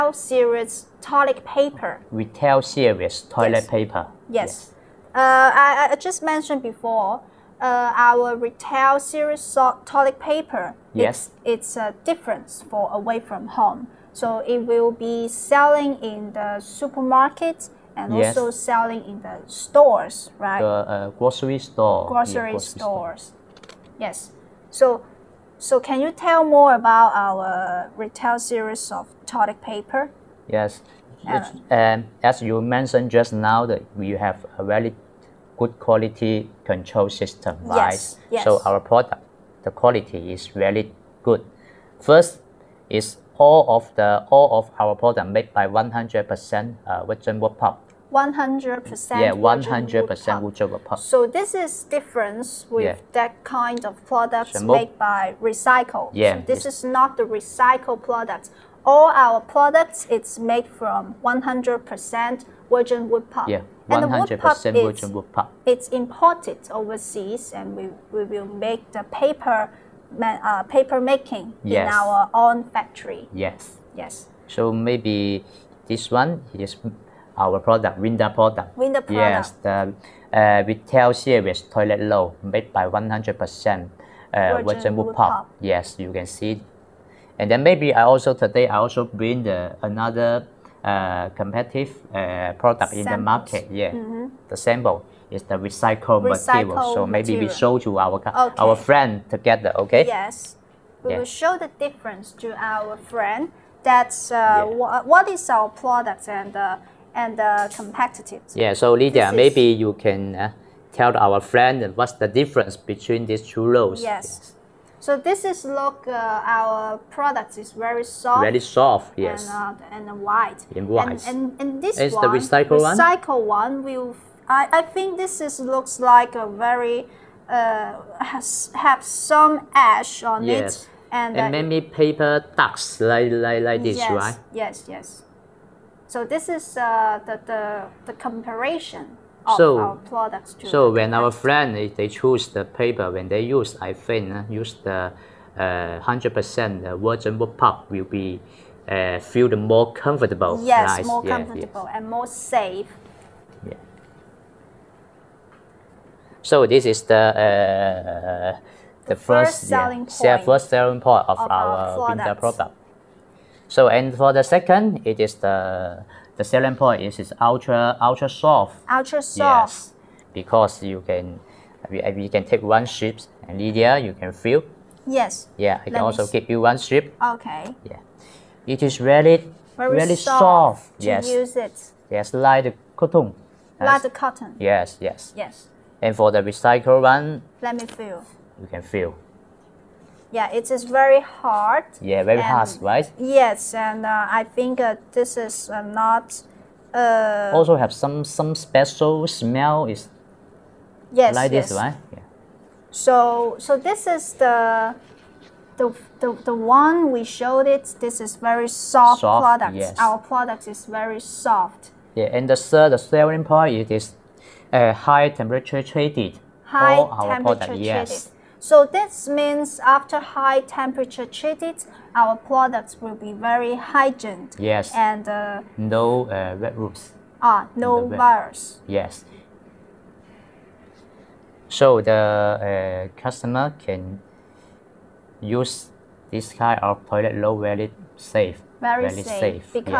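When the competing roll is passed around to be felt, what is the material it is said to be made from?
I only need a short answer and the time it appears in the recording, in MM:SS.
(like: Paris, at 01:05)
recycled material, at 01:35.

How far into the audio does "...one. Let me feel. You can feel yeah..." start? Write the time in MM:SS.
03:07.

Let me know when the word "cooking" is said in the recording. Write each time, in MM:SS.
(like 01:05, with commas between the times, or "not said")
not said.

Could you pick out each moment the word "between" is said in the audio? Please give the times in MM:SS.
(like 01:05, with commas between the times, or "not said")
01:52.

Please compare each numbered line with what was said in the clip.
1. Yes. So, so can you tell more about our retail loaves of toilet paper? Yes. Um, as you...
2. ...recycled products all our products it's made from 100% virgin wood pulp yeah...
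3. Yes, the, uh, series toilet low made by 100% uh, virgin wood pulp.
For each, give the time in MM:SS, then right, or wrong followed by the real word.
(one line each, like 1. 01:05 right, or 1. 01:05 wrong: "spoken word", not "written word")
1. 00:23 wrong: "series", not "loaves"
2. 00:57 right
3. 01:19 right.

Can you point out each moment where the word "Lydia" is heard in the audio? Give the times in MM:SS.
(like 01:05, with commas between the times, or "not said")
01:48, 02:53.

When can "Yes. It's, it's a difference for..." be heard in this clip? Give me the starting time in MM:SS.
00:10.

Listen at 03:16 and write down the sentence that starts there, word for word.
Uh, also have some some special smell is.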